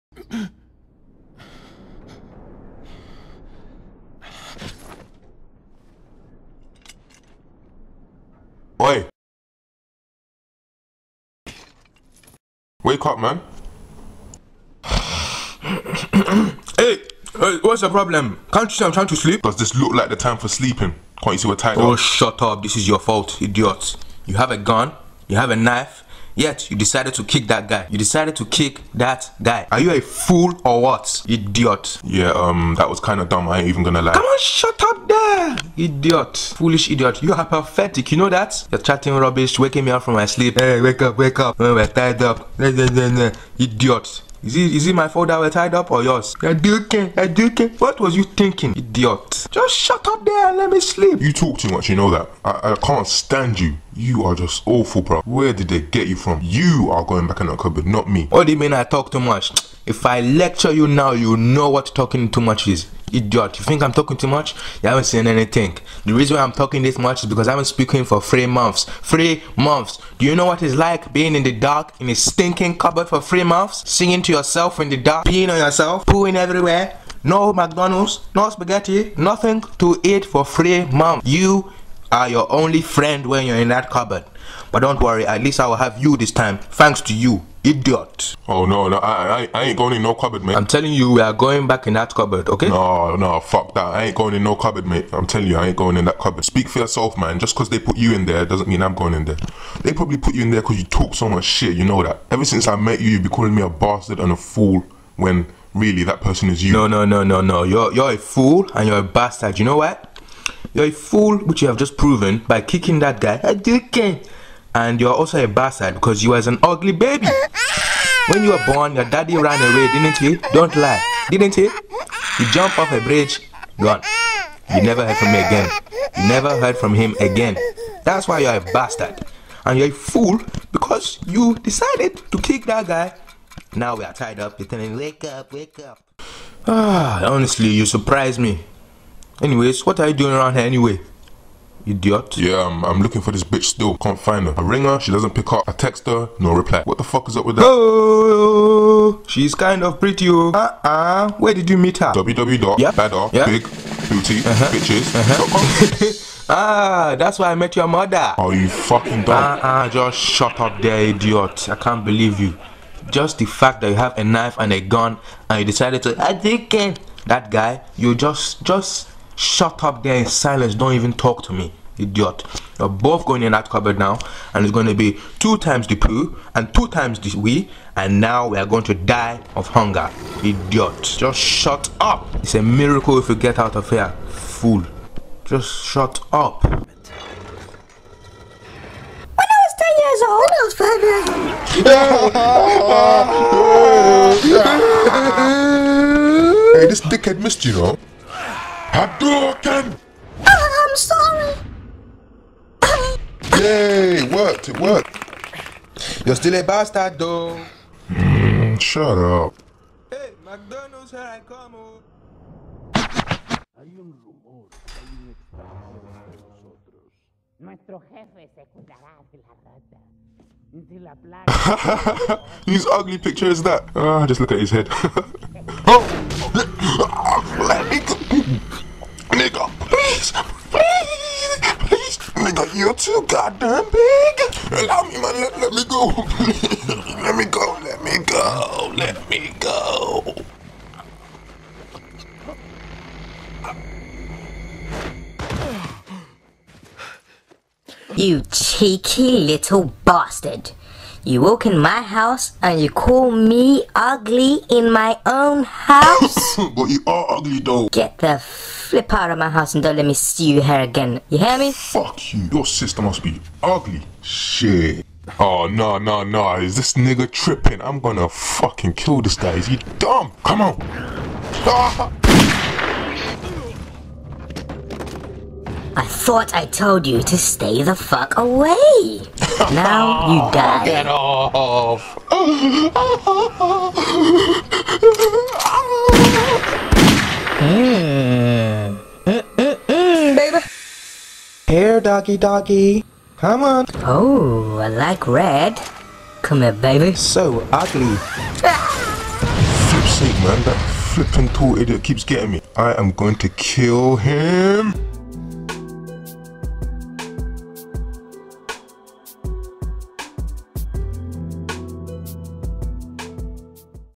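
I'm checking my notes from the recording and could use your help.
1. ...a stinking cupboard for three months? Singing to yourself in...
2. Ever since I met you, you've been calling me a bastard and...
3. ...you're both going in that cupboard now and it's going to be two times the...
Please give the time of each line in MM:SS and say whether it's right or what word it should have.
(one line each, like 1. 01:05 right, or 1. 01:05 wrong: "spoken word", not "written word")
1. 01:12 right
2. 01:42 right
3. 02:52 right.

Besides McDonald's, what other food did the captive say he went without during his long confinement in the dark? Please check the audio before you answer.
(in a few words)
spaghetti.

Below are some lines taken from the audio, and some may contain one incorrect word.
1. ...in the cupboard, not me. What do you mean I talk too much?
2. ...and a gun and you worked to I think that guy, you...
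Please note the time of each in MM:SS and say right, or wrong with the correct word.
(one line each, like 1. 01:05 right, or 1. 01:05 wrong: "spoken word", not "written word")
1. 00:57 right
2. 02:44 wrong: "decided", not "worked".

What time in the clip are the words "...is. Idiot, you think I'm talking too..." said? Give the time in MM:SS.
01:02.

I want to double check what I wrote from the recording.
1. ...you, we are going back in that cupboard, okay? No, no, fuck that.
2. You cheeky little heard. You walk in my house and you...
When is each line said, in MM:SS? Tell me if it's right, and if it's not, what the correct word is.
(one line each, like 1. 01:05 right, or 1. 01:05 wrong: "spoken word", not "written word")
1. 01:30 right
2. 04:08 wrong: "bastard", not "heard".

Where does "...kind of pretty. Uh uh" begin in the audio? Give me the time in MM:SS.
02:29.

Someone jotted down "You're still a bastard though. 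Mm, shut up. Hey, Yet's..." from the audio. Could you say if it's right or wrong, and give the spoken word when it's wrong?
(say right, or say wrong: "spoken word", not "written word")
wrong: "McDonald", not "Yet".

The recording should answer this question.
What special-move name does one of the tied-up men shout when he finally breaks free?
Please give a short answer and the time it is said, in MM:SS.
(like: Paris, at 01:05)
Hadouken, at 03:18.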